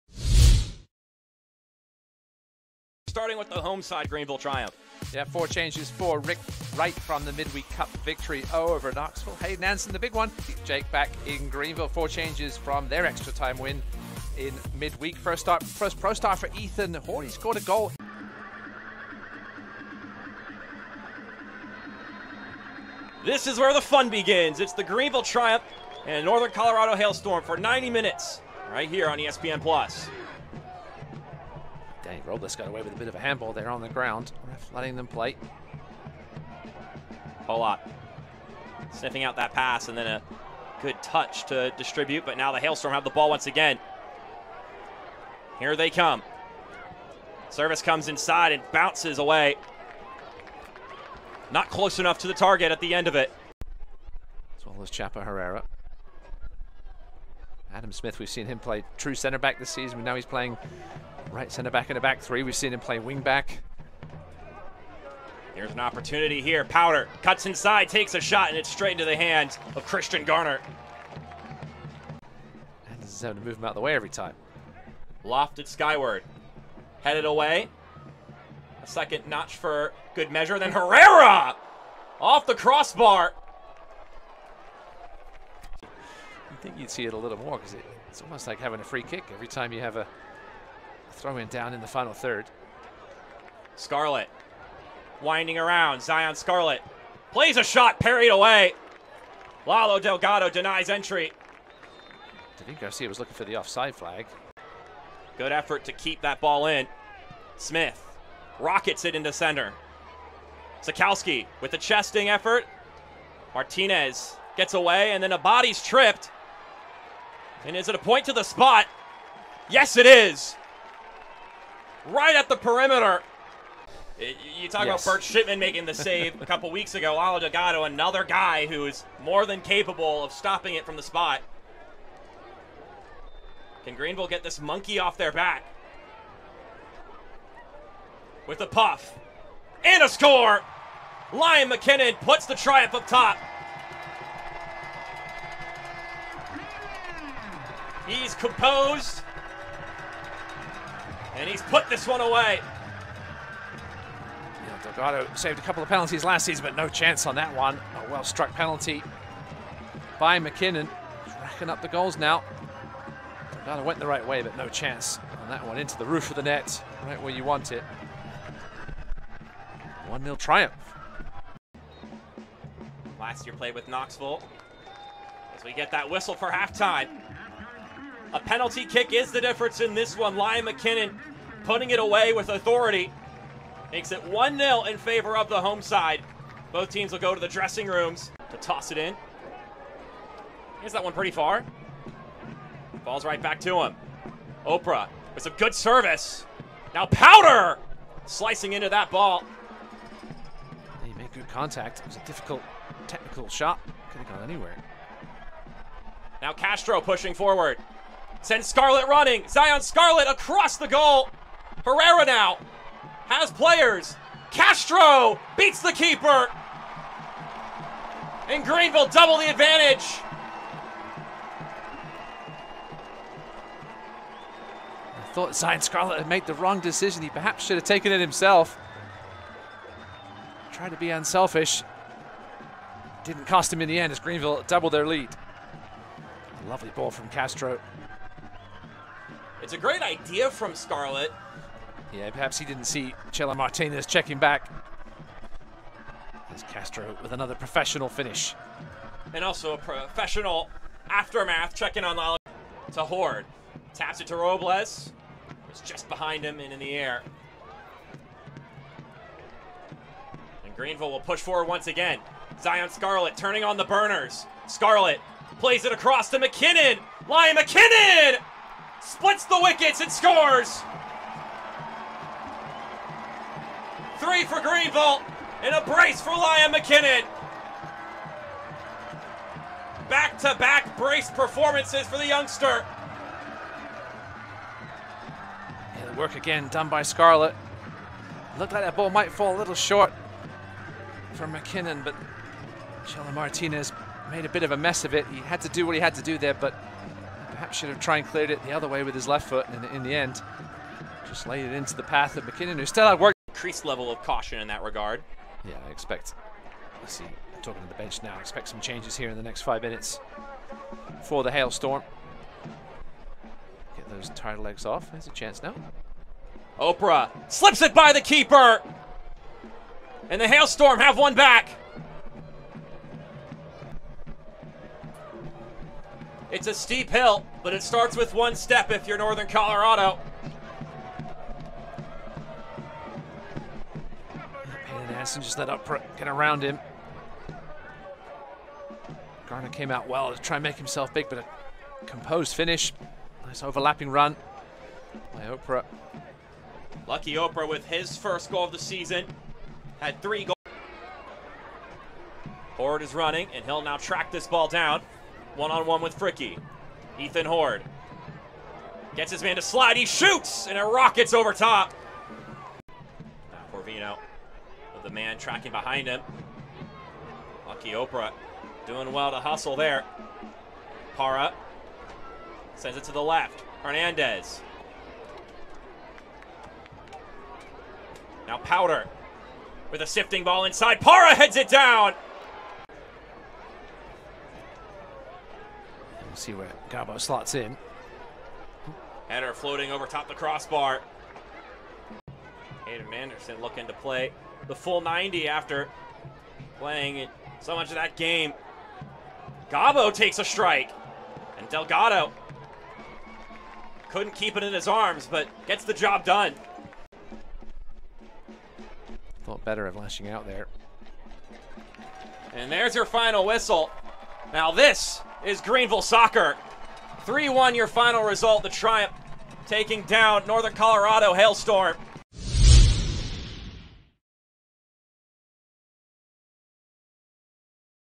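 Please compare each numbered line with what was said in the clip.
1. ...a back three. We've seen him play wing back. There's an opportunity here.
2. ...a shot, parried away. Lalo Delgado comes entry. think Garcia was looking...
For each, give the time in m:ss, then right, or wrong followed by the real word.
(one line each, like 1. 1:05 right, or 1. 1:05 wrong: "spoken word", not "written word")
1. 1:01 right
2. 1:37 wrong: "denies", not "comes".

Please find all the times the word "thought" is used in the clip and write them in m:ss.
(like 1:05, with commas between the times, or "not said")
3:45, 6:49.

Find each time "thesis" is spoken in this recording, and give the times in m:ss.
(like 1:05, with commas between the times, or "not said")
not said.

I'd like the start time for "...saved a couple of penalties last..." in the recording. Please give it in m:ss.
2:35.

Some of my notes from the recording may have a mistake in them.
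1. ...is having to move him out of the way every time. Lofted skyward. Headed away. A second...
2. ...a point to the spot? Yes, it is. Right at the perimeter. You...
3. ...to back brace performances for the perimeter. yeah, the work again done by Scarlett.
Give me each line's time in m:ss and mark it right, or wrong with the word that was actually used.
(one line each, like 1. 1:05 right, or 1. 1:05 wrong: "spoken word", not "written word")
1. 1:13 right
2. 1:57 right
3. 4:40 wrong: "youngster", not "perimeter".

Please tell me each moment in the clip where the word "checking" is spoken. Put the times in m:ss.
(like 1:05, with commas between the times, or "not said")
4:04, 4:11.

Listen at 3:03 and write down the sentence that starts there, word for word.
Makes it 1 0 in favor of the home side.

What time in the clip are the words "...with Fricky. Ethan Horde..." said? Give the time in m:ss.
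5:56.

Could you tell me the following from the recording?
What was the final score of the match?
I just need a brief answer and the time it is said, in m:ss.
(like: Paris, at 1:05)
3-1, at 6:57.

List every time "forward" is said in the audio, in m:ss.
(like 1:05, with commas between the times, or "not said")
3:27, 4:21.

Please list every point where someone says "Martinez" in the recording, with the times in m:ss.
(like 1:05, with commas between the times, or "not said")
1:53, 4:03, 4:53.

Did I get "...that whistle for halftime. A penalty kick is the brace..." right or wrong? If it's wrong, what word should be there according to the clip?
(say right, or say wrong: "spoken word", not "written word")
wrong: "difference", not "brace".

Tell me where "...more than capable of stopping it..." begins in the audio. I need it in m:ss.
2:09.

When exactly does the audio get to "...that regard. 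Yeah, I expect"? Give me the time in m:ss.
5:04.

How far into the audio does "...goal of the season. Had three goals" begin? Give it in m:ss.
5:48.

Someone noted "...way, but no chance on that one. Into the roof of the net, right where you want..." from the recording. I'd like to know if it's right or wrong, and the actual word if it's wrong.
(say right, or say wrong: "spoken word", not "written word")
right.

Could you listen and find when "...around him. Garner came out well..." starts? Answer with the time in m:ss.
5:36.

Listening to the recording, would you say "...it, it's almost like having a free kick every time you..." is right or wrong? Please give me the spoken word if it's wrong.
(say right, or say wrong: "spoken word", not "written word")
right.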